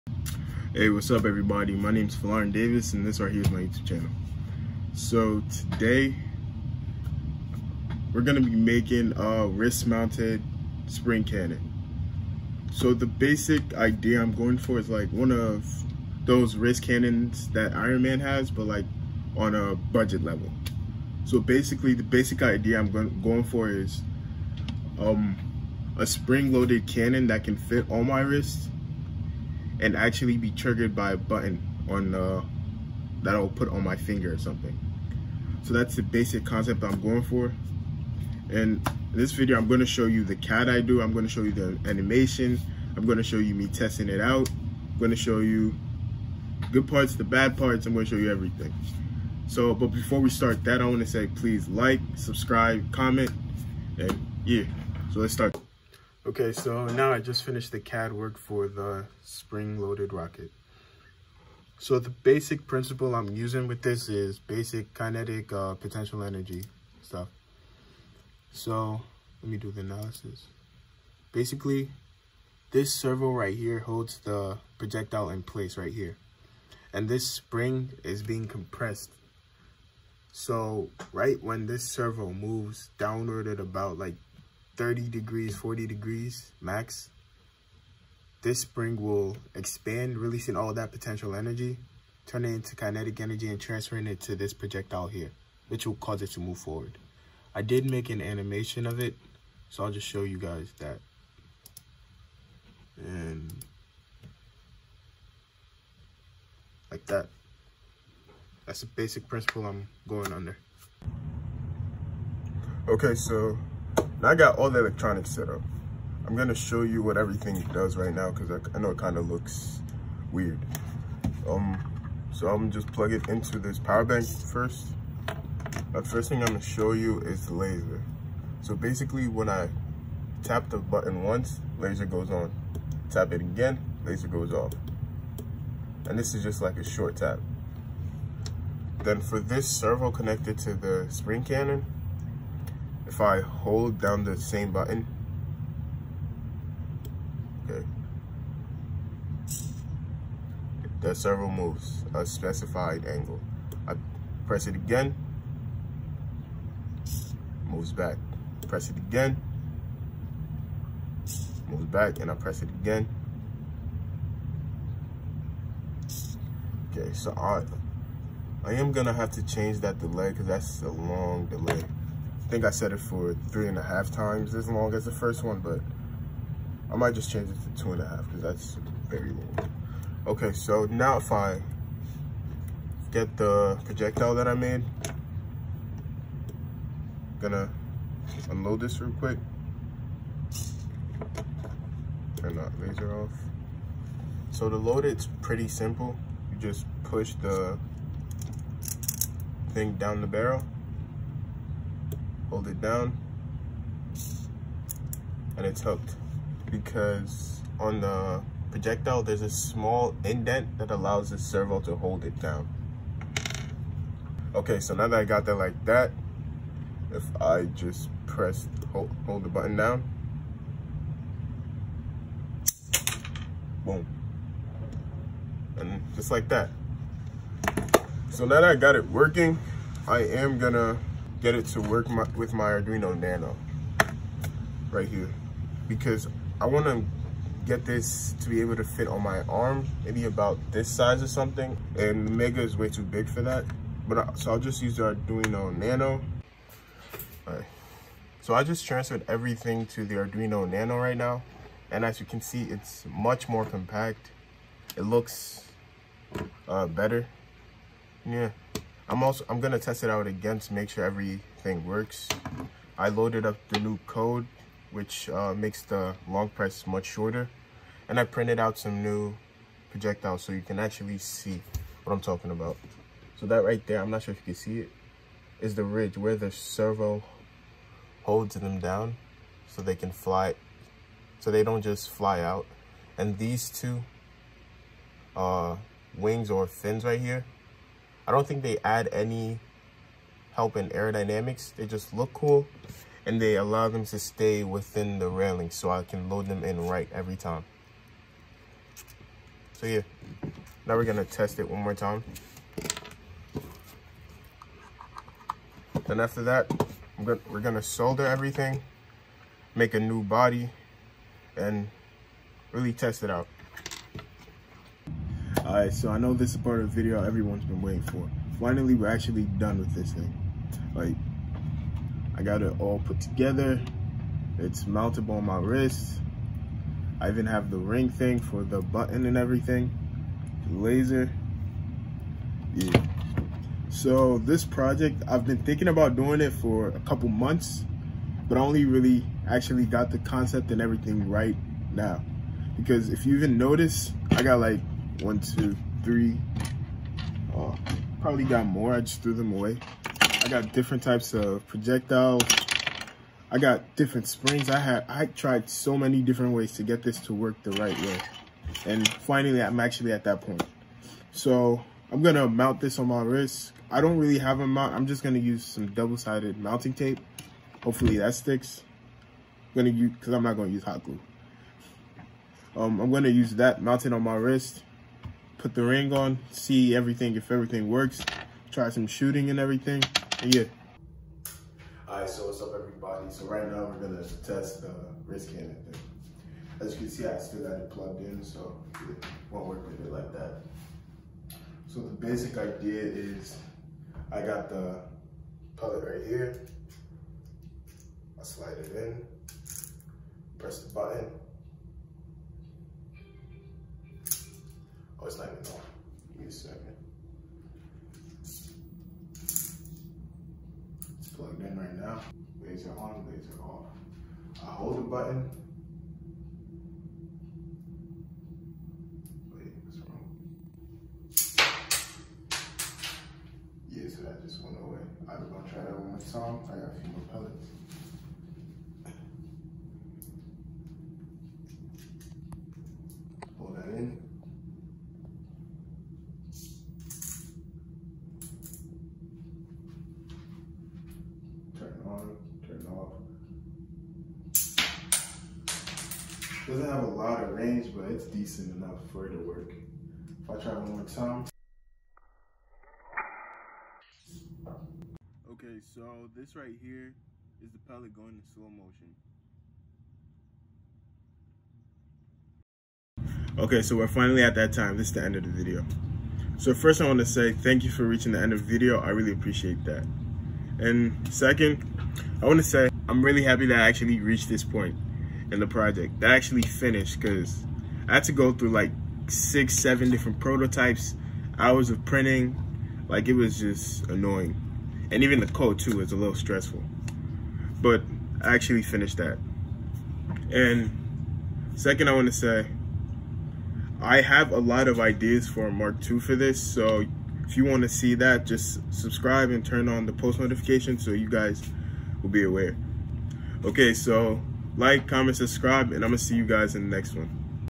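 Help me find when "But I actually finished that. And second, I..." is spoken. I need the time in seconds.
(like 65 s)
487 s.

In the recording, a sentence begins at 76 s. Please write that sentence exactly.
And this spring is being compressed.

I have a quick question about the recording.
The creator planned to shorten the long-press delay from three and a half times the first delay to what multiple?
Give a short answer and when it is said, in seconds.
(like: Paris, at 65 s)
2.5, at 177 s.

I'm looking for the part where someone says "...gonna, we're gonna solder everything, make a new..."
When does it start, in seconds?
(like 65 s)
307 s.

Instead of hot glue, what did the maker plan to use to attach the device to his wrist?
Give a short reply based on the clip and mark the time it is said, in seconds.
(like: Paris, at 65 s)
double-sided mounting tape, at 365 s.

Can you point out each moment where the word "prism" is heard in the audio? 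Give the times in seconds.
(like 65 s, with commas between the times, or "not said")
not said.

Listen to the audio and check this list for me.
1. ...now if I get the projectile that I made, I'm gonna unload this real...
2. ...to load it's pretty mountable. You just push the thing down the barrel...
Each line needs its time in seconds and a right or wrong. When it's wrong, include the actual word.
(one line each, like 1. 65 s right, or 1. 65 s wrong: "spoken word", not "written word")
1. 180 s right
2. 194 s wrong: "simple", not "mountable".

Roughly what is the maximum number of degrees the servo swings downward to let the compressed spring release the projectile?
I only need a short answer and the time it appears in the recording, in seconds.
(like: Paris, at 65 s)
40 degrees, at 85 s.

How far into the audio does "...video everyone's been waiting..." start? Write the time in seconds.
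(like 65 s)
317 s.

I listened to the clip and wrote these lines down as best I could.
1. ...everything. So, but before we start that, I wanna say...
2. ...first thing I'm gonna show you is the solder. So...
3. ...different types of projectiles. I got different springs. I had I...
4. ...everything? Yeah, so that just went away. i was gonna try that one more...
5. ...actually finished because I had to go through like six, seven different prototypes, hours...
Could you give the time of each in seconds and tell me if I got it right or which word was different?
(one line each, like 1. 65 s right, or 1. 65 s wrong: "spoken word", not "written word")
1. 48 s right
2. 126 s wrong: "laser", not "solder"
3. 350 s right
4. 420 s wrong: "wrong", not "everything"
5. 476 s right.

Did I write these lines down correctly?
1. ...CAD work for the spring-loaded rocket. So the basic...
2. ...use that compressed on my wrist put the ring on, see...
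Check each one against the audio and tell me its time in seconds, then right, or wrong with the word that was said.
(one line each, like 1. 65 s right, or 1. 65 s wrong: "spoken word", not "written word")
1. 57 s right
2. 373 s wrong: "mounted", not "compressed".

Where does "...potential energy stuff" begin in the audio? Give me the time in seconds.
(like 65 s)
65 s.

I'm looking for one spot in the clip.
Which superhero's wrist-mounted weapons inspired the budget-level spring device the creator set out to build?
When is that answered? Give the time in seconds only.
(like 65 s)
17 s.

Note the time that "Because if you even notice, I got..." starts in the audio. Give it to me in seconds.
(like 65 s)
342 s.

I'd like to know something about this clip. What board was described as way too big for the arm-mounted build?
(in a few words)
the Mega.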